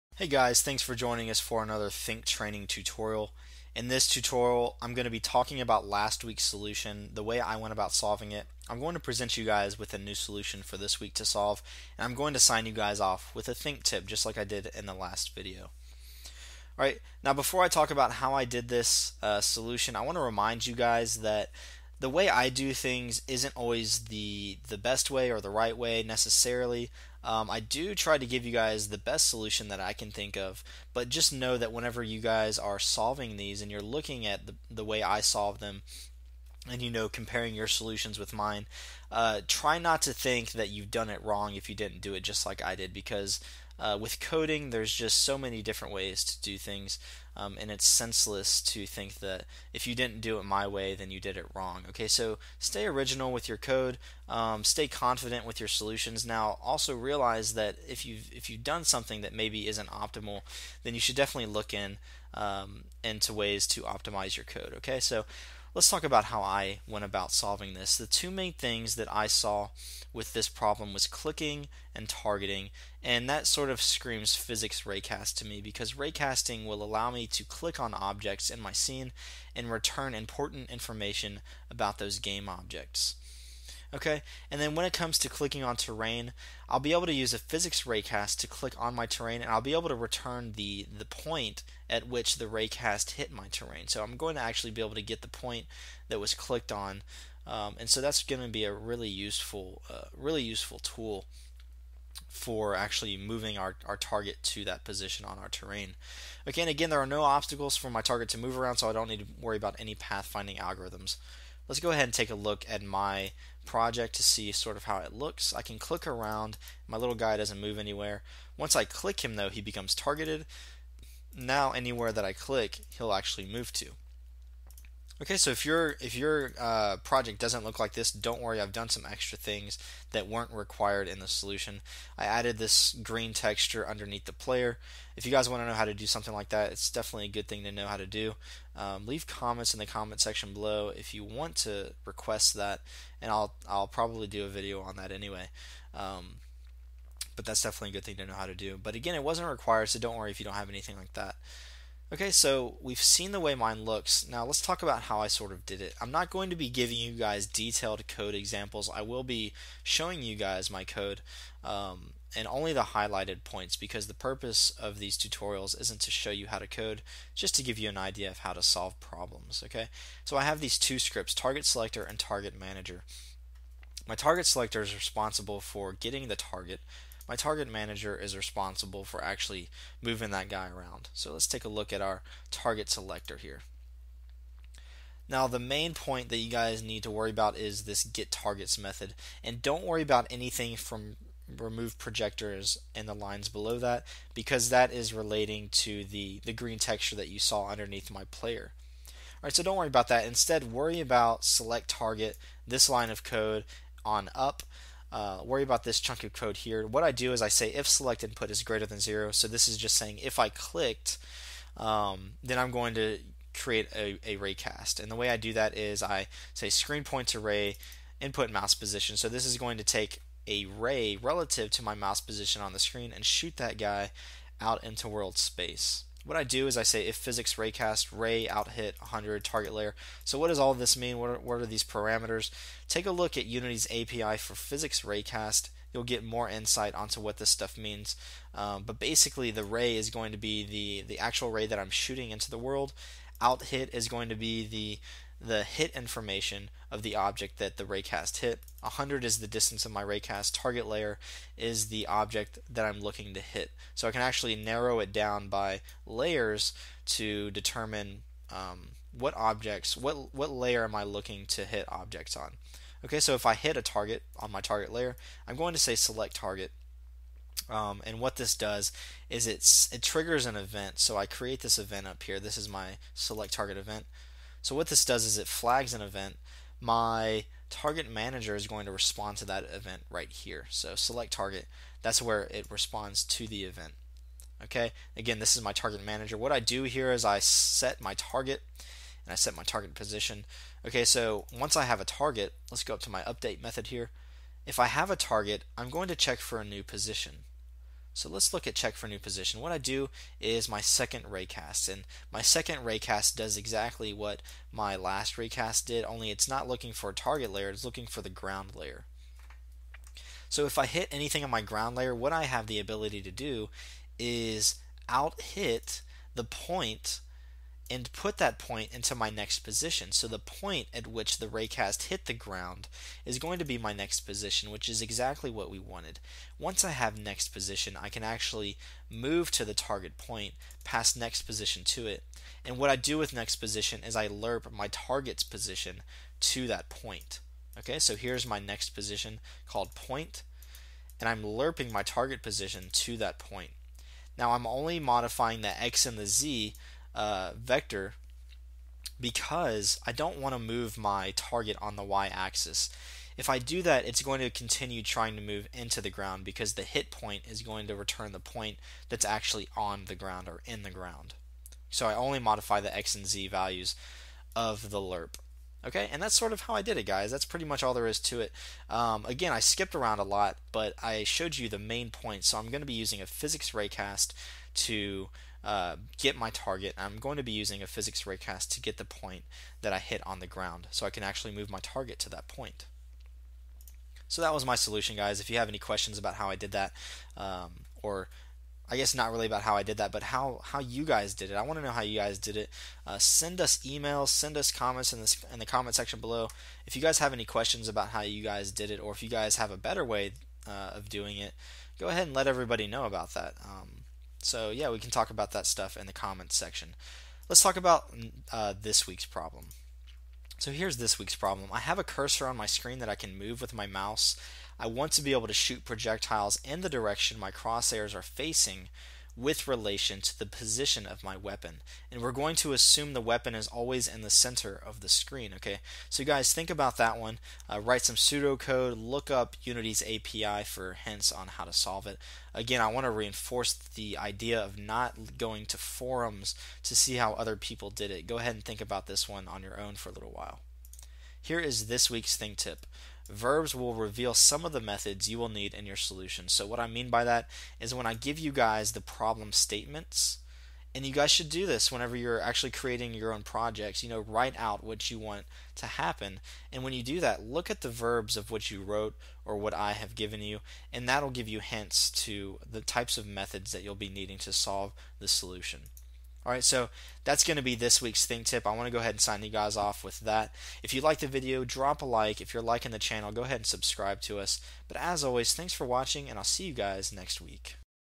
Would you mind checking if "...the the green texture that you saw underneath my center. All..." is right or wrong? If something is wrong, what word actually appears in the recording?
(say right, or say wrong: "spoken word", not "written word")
wrong: "player", not "center".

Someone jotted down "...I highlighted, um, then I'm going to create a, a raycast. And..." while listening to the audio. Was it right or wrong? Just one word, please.
wrong.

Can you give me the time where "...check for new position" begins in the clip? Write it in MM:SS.
04:58.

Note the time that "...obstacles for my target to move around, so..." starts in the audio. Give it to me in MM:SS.
01:47.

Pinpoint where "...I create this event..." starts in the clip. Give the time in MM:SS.
04:31.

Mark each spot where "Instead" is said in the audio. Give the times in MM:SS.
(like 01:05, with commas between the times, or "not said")
03:20.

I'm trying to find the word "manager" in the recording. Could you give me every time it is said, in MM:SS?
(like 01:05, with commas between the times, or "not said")
02:52, 02:57, 04:38, 04:46.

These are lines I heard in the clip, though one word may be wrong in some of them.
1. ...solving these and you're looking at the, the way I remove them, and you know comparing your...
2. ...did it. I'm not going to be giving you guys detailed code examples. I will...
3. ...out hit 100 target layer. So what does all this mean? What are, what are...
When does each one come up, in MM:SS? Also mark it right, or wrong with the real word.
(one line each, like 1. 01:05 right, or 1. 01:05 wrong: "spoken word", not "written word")
1. 00:32 wrong: "solve", not "remove"
2. 02:35 right
3. 03:48 right.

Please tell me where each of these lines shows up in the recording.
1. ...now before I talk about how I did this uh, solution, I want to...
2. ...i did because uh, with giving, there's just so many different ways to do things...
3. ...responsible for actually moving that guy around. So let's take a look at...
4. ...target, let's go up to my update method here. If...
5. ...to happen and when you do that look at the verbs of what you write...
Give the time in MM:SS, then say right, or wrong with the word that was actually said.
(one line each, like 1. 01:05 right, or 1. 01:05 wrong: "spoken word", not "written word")
1. 00:17 right
2. 00:42 wrong: "coding", not "giving"
3. 02:58 right
4. 04:52 right
5. 07:35 wrong: "wrote", not "write".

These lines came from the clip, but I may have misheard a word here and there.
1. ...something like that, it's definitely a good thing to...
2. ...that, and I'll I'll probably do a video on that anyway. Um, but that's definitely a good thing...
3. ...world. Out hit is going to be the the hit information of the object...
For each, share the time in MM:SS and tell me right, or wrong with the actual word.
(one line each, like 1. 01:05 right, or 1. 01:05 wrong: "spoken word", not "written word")
1. 02:16 right
2. 02:22 right
3. 04:02 right.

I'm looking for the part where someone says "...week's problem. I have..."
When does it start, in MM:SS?
06:51.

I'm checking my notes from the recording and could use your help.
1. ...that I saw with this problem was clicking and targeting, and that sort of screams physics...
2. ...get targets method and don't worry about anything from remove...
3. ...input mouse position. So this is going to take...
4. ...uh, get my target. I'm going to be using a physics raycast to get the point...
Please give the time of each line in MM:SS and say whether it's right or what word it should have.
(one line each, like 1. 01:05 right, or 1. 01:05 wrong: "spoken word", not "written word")
1. 01:08 right
2. 03:08 right
3. 03:38 right
4. 06:15 right.